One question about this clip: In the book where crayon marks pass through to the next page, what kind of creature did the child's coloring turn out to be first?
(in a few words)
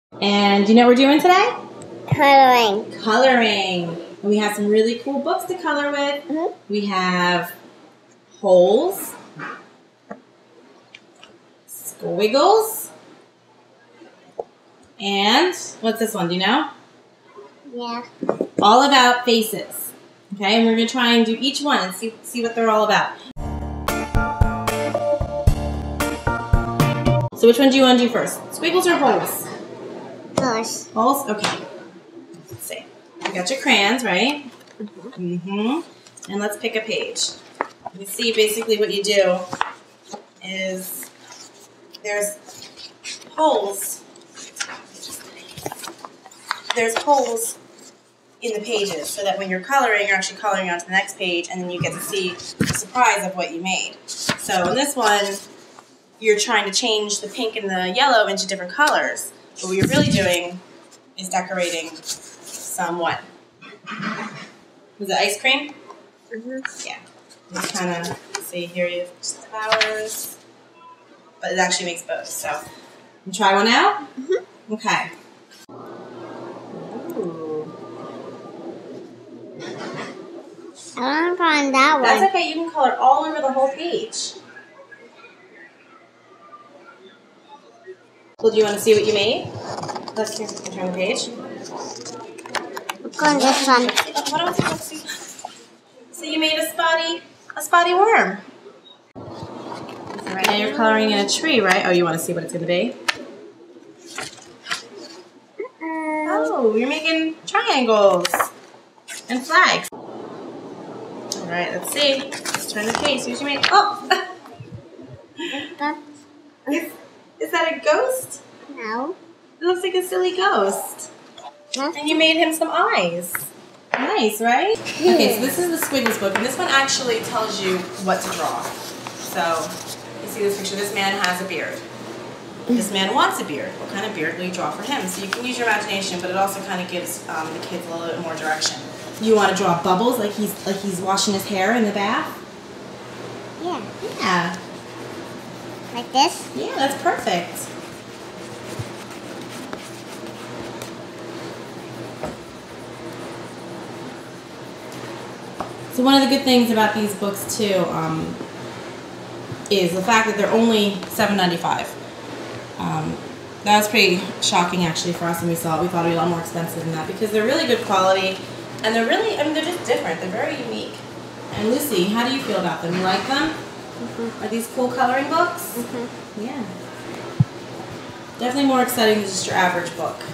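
A spotty worm.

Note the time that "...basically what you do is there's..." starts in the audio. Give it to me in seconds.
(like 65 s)
38 s.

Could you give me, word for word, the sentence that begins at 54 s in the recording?
So in this one, you're trying to change the pink and the yellow into different colors.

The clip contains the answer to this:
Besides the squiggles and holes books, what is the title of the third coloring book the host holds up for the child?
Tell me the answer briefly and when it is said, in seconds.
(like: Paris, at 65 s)
All about faces, at 18 s.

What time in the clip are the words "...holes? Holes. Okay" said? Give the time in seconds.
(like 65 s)
29 s.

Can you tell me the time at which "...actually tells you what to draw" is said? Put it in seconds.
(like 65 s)
126 s.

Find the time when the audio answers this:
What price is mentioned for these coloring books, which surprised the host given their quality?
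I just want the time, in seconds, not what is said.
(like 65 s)
161 s.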